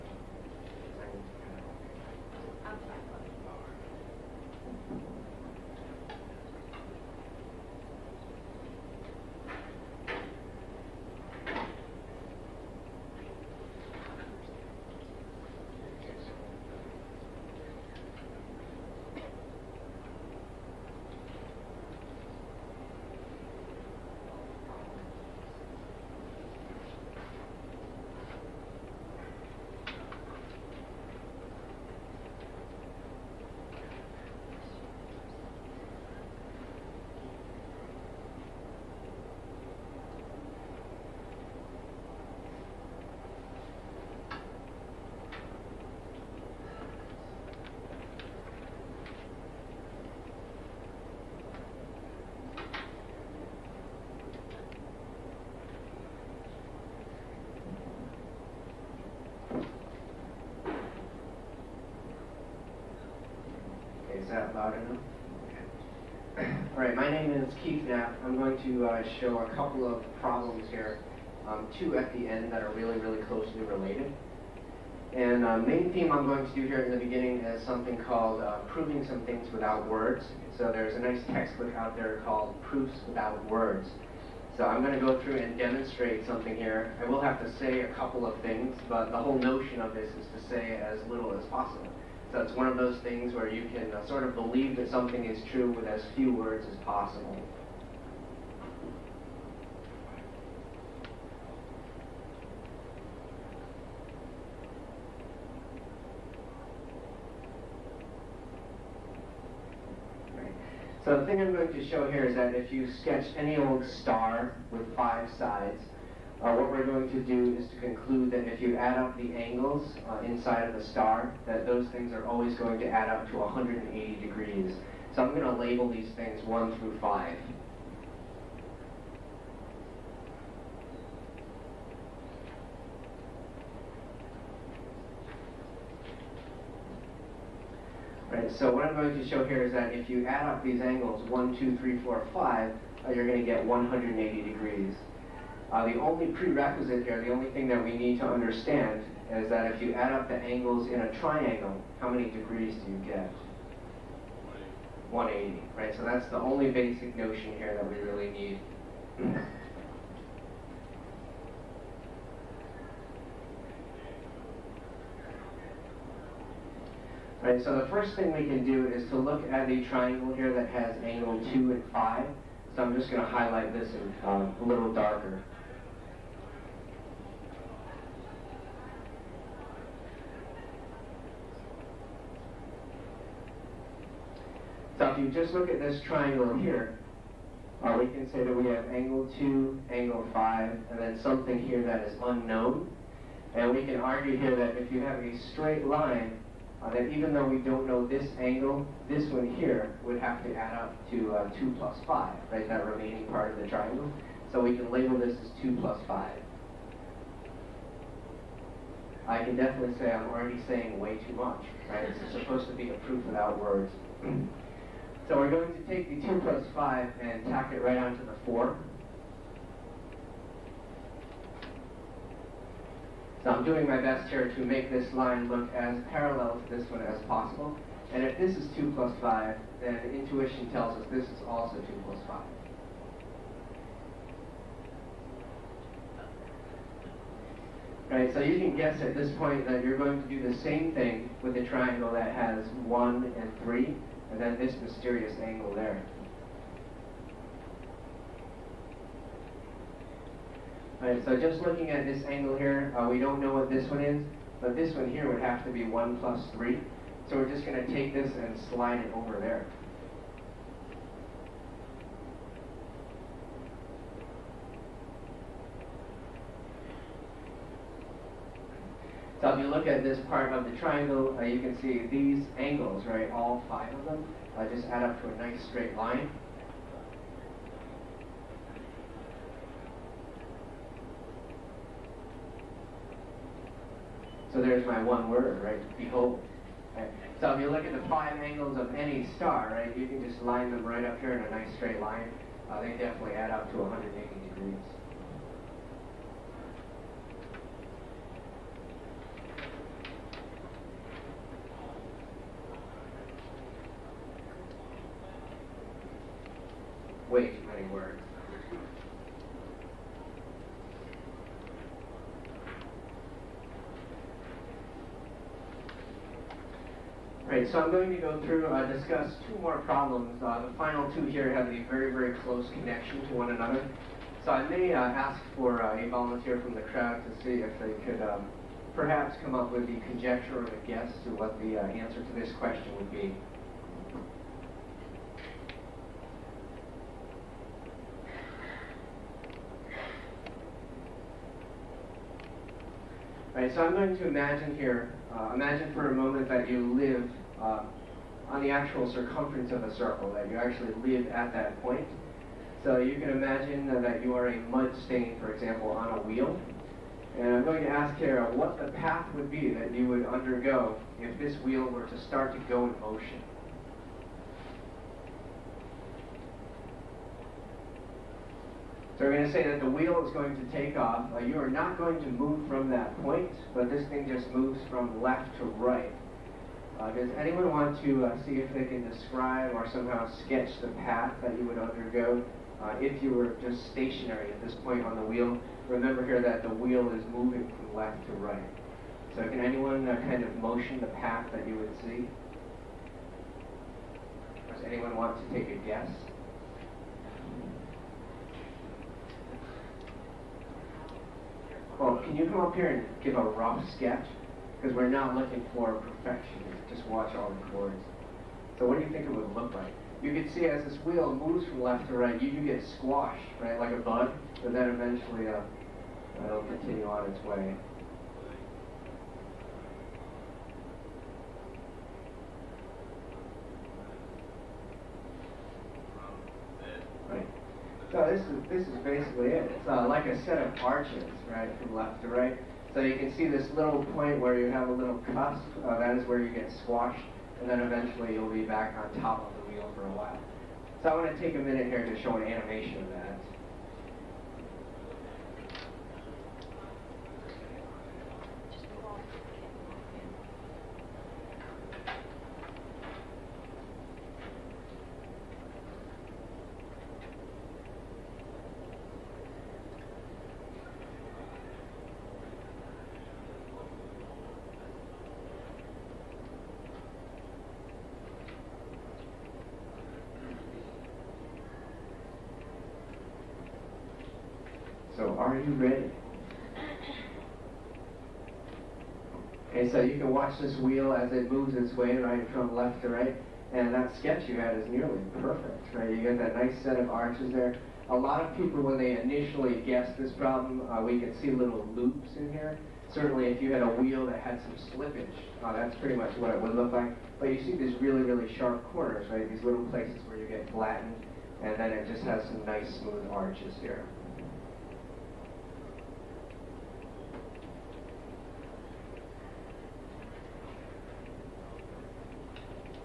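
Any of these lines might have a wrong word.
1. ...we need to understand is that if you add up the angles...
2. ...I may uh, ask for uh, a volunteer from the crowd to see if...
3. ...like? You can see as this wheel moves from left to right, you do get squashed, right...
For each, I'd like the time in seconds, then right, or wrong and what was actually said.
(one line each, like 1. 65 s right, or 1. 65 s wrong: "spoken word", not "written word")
1. 147 s right
2. 324 s right
3. 409 s right.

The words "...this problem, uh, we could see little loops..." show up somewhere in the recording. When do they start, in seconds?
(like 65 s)
490 s.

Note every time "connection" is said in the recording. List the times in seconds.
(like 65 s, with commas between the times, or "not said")
322 s.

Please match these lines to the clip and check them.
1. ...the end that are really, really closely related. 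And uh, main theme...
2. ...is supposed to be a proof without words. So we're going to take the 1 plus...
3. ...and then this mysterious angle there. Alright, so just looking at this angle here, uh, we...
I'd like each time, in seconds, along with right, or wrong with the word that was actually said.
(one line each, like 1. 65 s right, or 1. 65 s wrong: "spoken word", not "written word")
1. 72 s right
2. 212 s wrong: "2", not "1"
3. 244 s right.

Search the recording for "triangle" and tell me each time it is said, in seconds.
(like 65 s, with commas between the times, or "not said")
151 s, 169 s, 186 s, 203 s, 241 s, 270 s.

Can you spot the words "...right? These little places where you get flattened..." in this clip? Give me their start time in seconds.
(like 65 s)
499 s.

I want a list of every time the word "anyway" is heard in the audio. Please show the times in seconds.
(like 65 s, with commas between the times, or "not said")
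not said.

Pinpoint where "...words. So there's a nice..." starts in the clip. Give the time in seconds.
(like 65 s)
79 s.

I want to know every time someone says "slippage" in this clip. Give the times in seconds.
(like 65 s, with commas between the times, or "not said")
494 s.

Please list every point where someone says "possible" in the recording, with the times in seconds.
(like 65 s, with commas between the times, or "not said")
91 s, 96 s, 227 s.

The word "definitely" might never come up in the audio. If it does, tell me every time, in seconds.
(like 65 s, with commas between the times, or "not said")
209 s, 292 s.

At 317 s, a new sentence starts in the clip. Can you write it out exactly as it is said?
Right, so I'm going to go through uh, discuss two more problems.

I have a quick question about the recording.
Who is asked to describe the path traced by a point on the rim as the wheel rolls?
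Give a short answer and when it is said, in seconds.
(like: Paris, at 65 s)
Kara, at 358 s.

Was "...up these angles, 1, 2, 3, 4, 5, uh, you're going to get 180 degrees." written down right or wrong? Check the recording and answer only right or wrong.
right.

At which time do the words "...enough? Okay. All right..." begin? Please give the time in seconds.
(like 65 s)
64 s.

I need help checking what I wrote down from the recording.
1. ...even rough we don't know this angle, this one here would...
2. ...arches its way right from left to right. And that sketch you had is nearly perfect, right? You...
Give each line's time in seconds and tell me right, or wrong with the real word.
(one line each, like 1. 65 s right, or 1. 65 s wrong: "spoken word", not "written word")
1. 197 s wrong: "though", not "rough"
2. 481 s wrong: "moves", not "arches".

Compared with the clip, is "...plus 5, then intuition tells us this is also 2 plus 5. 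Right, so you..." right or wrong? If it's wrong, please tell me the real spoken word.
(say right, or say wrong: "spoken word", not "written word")
right.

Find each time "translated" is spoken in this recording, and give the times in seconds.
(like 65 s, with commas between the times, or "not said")
not said.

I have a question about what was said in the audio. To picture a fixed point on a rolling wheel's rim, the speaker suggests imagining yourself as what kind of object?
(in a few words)
a mud stain.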